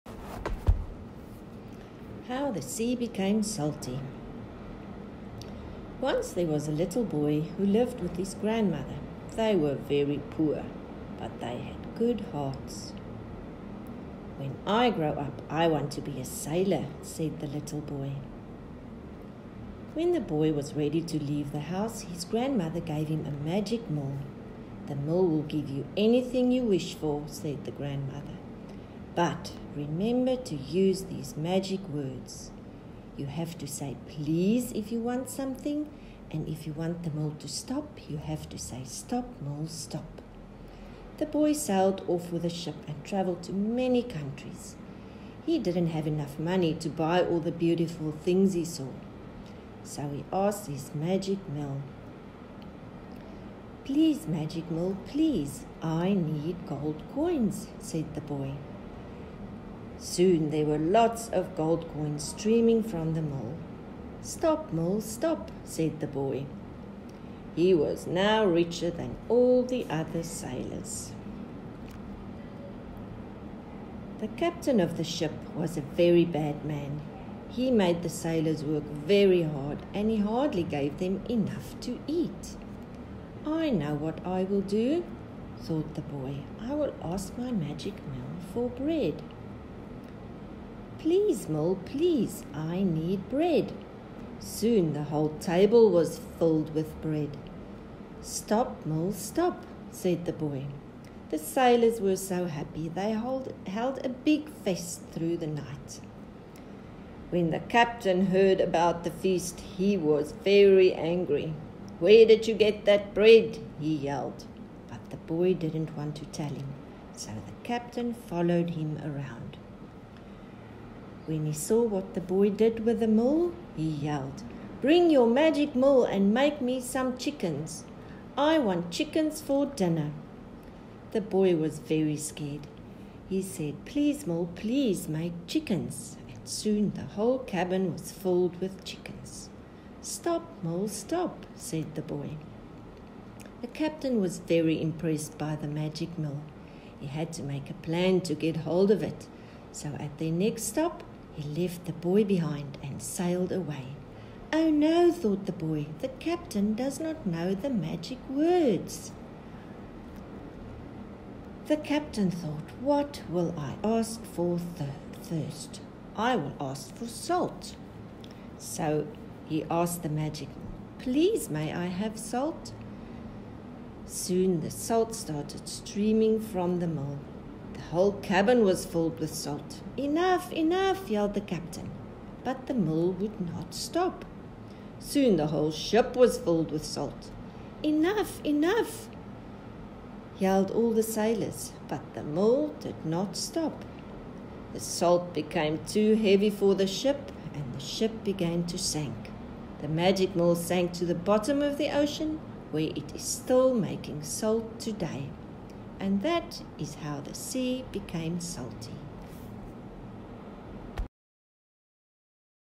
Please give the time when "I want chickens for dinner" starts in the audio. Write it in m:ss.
2:08.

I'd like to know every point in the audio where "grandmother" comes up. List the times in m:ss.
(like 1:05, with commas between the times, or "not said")
0:08, 0:22, 0:27.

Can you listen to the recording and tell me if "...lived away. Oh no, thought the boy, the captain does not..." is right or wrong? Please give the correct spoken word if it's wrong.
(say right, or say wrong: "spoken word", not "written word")
wrong: "sailed", not "lived".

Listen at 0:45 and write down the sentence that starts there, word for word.
He didn't have enough money to buy all the beautiful things he saw.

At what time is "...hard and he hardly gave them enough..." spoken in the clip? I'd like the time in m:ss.
1:19.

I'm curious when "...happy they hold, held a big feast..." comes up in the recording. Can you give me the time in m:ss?
1:42.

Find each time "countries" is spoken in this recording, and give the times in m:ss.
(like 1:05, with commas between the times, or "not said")
0:44.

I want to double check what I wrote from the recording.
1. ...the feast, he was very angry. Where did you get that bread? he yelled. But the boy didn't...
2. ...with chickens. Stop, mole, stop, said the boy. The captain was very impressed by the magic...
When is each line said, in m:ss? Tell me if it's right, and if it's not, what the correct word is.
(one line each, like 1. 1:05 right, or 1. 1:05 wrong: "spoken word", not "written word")
1. 1:49 right
2. 2:18 right.